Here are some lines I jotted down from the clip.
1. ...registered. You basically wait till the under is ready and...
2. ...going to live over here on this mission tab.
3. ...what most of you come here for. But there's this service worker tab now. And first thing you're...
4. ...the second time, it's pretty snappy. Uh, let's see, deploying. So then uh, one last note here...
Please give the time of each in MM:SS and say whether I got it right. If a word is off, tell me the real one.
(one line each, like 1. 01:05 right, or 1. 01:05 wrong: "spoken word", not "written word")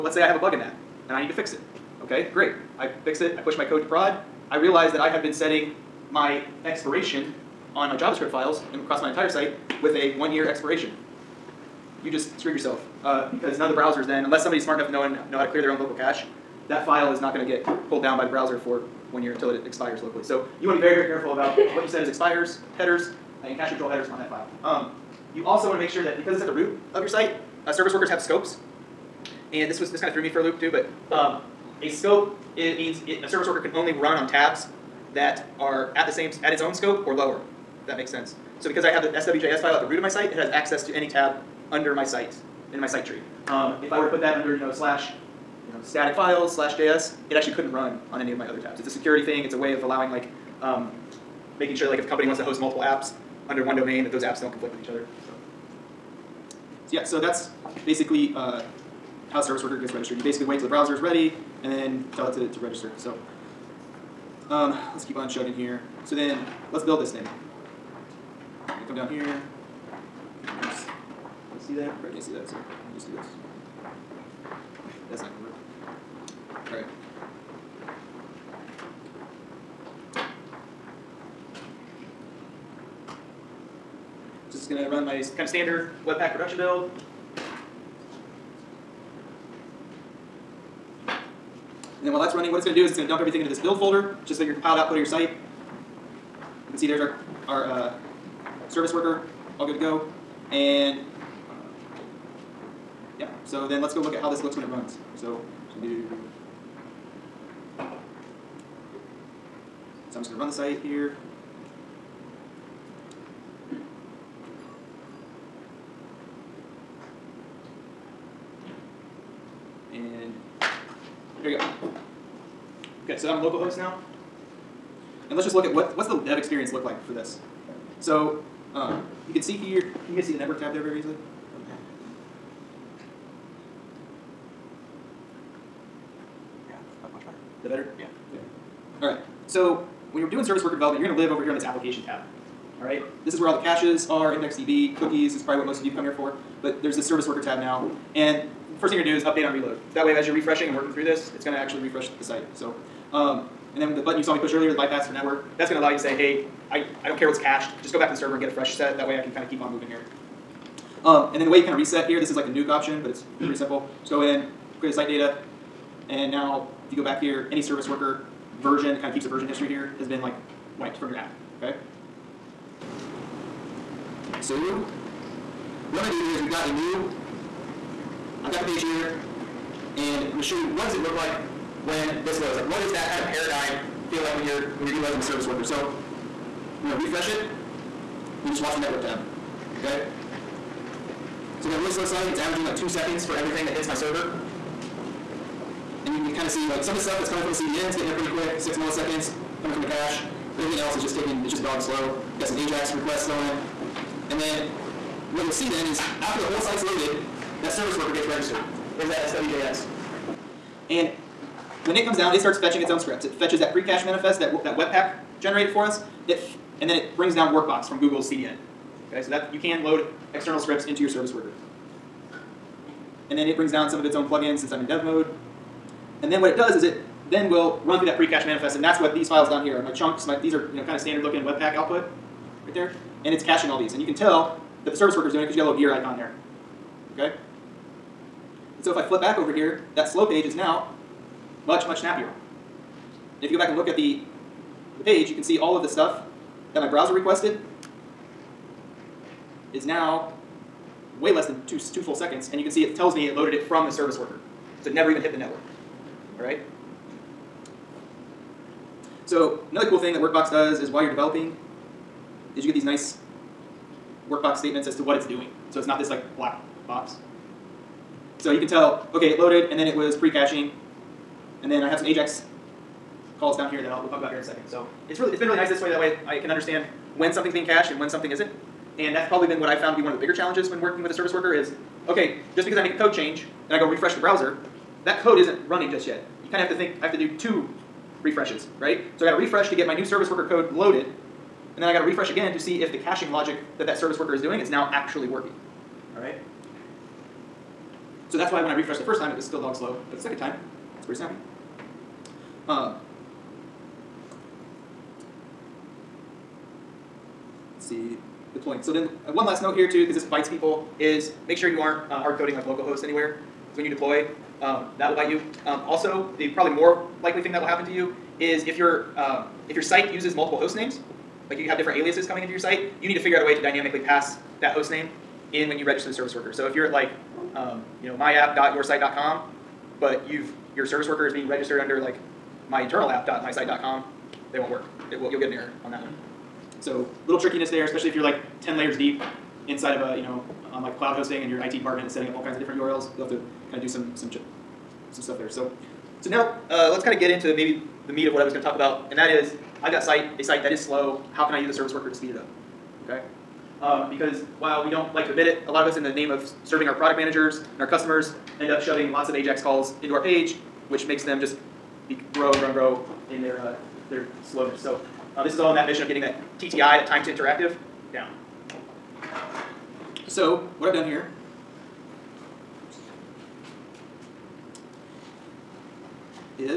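1. 00:59 wrong: "browser", not "under"
2. 02:21 wrong: "application", not "mission"
3. 02:25 right
4. 05:00 right.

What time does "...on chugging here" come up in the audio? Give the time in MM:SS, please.
01:05.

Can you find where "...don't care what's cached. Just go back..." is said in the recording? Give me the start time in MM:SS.
02:37.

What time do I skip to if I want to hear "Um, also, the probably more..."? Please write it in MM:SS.
05:15.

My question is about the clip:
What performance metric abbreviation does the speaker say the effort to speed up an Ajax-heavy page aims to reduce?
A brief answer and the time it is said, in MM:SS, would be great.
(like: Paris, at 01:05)
TTI, at 06:06.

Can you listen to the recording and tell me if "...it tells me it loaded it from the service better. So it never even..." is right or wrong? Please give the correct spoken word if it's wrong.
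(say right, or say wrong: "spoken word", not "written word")
wrong: "worker", not "better".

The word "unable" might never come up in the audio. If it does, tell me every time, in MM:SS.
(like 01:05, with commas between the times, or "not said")
not said.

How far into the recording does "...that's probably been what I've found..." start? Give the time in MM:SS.
04:39.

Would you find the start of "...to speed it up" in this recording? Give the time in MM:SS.
05:52.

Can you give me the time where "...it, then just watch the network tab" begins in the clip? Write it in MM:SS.
03:07.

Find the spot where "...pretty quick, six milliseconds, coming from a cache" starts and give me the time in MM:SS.
03:18.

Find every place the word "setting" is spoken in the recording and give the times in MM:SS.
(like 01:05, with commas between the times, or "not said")
00:05, 05:42.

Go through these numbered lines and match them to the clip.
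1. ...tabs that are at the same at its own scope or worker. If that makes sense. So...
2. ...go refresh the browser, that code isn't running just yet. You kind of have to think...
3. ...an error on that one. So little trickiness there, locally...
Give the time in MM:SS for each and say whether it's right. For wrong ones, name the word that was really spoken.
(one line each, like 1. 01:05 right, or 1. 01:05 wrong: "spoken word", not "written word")
1. 00:34 wrong: "lower", not "worker"
2. 04:43 right
3. 05:35 wrong: "especially", not "locally".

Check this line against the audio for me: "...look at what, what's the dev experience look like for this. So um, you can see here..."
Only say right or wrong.
right.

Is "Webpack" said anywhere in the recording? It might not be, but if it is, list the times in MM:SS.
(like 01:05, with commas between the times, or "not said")
01:26, 03:34, 03:51.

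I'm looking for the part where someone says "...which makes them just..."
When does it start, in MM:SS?
06:00.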